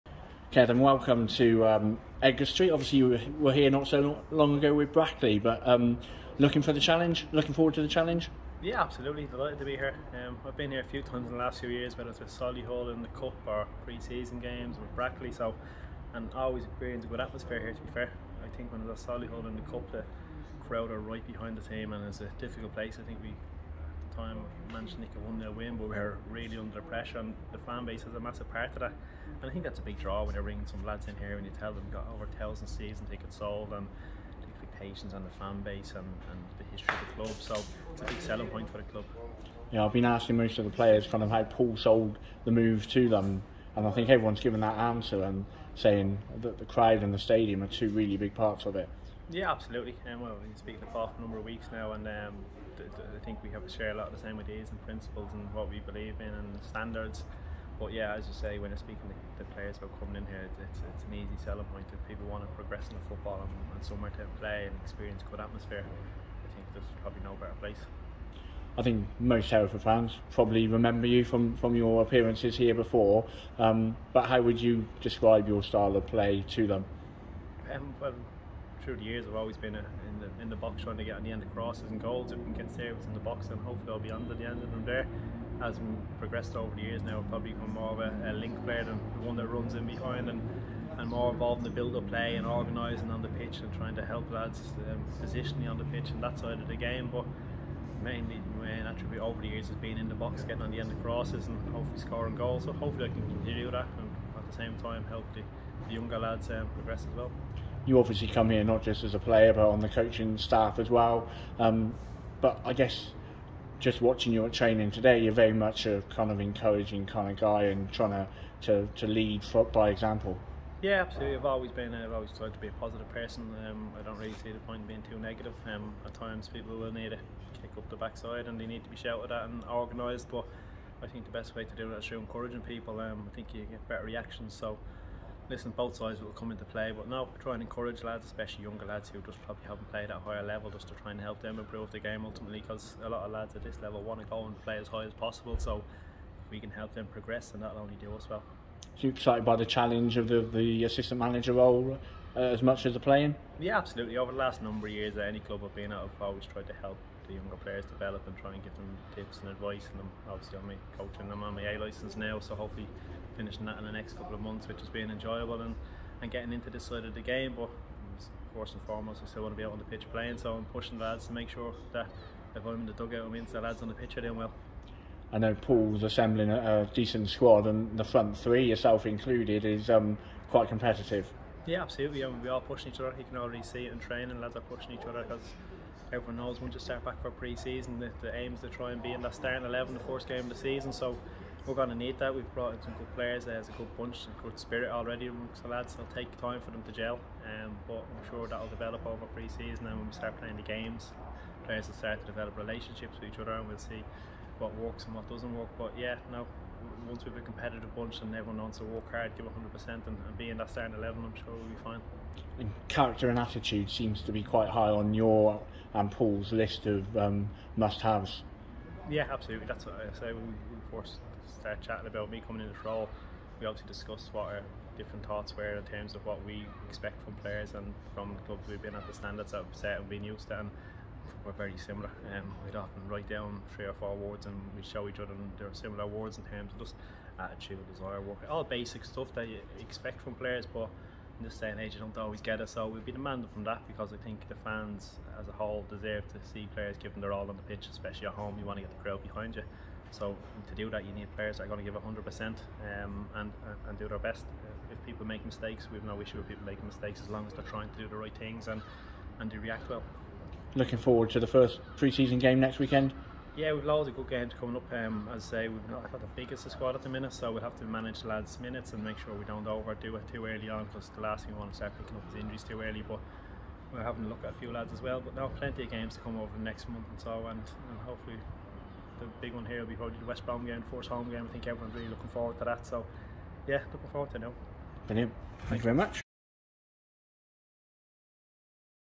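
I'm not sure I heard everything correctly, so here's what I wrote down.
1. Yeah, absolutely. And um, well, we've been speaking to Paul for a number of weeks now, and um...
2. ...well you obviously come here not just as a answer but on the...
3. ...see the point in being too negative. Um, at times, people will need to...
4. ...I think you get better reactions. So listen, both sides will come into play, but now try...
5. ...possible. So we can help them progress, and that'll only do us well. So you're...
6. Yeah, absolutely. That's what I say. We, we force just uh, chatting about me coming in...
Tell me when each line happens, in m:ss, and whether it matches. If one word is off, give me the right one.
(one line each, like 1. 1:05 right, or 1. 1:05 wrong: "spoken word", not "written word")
1. 0:49 right
2. 1:47 wrong: "player", not "answer"
3. 2:04 right
4. 2:13 right
5. 2:25 right
6. 3:39 right.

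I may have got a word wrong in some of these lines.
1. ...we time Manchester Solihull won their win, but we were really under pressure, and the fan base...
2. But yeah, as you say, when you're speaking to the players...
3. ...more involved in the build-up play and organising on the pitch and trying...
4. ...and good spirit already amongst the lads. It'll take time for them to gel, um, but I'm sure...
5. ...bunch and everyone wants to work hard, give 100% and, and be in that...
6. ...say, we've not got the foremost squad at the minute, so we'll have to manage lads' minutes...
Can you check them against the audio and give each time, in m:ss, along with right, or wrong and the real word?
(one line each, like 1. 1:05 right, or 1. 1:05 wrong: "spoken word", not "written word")
1. 0:23 wrong: "United", not "Solihull"
2. 0:57 right
3. 1:31 right
4. 3:14 right
5. 3:27 right
6. 4:25 wrong: "biggest", not "foremost".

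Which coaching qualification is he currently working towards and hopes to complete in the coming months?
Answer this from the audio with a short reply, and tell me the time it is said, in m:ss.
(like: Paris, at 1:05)
A license, at 2:41.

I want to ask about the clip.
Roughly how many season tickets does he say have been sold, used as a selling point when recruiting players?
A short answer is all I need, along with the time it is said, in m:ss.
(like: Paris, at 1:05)
over 1,000, at 0:32.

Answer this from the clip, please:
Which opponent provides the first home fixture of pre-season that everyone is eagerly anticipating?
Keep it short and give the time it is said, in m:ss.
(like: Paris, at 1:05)
West Brom, at 4:40.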